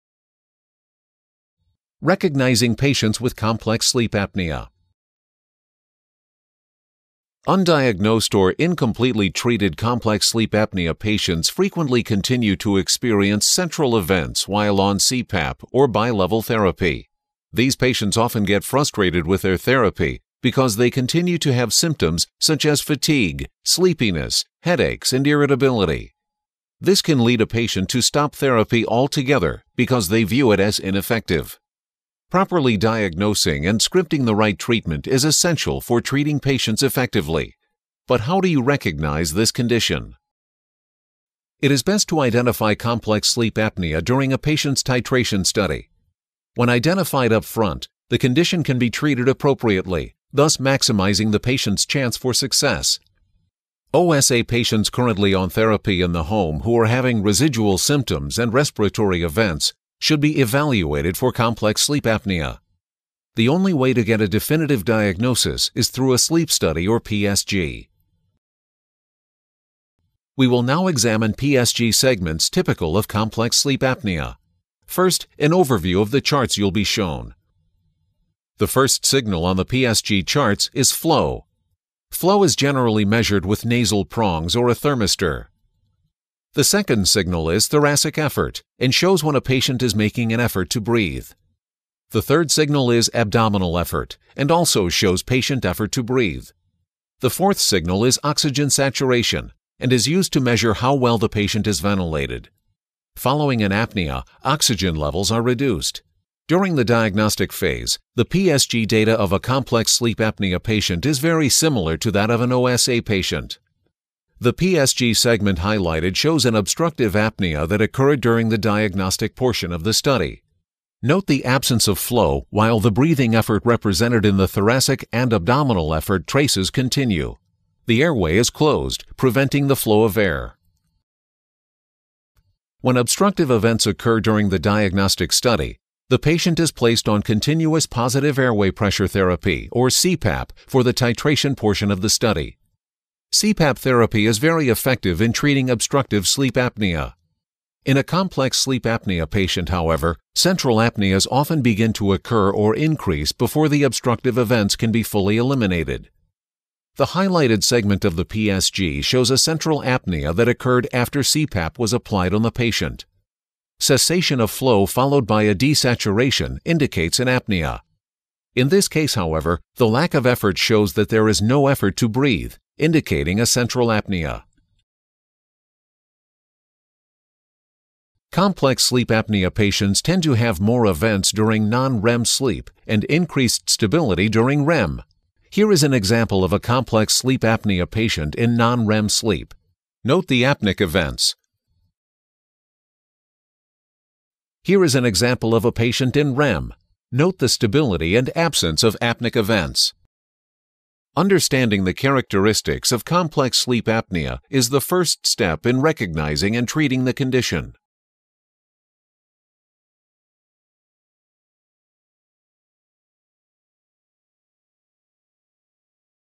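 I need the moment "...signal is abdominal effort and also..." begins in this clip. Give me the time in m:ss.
1:32.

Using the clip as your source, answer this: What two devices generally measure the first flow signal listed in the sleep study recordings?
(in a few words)
nasal prongs or a thermistor.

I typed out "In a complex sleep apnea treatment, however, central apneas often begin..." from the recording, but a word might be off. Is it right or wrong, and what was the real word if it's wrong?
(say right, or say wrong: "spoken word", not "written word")
wrong: "patient", not "treatment".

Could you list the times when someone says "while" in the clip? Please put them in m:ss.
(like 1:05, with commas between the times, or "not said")
0:14, 2:02.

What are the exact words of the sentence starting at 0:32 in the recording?
Properly diagnosing and scripting the right treatment is essential for treating patients effectively.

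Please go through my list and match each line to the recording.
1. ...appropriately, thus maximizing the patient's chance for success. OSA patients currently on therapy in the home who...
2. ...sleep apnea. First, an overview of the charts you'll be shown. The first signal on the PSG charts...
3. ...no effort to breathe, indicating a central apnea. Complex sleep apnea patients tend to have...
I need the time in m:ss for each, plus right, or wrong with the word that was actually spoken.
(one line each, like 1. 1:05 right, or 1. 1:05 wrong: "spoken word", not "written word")
1. 0:49 right
2. 1:13 right
3. 2:51 right.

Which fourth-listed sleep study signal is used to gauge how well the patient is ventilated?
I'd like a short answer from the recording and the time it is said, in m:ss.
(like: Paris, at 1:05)
oxygen saturation, at 1:38.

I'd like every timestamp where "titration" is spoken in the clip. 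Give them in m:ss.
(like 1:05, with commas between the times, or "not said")
0:44, 2:20.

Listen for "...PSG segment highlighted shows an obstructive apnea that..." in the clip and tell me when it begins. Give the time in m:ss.
1:54.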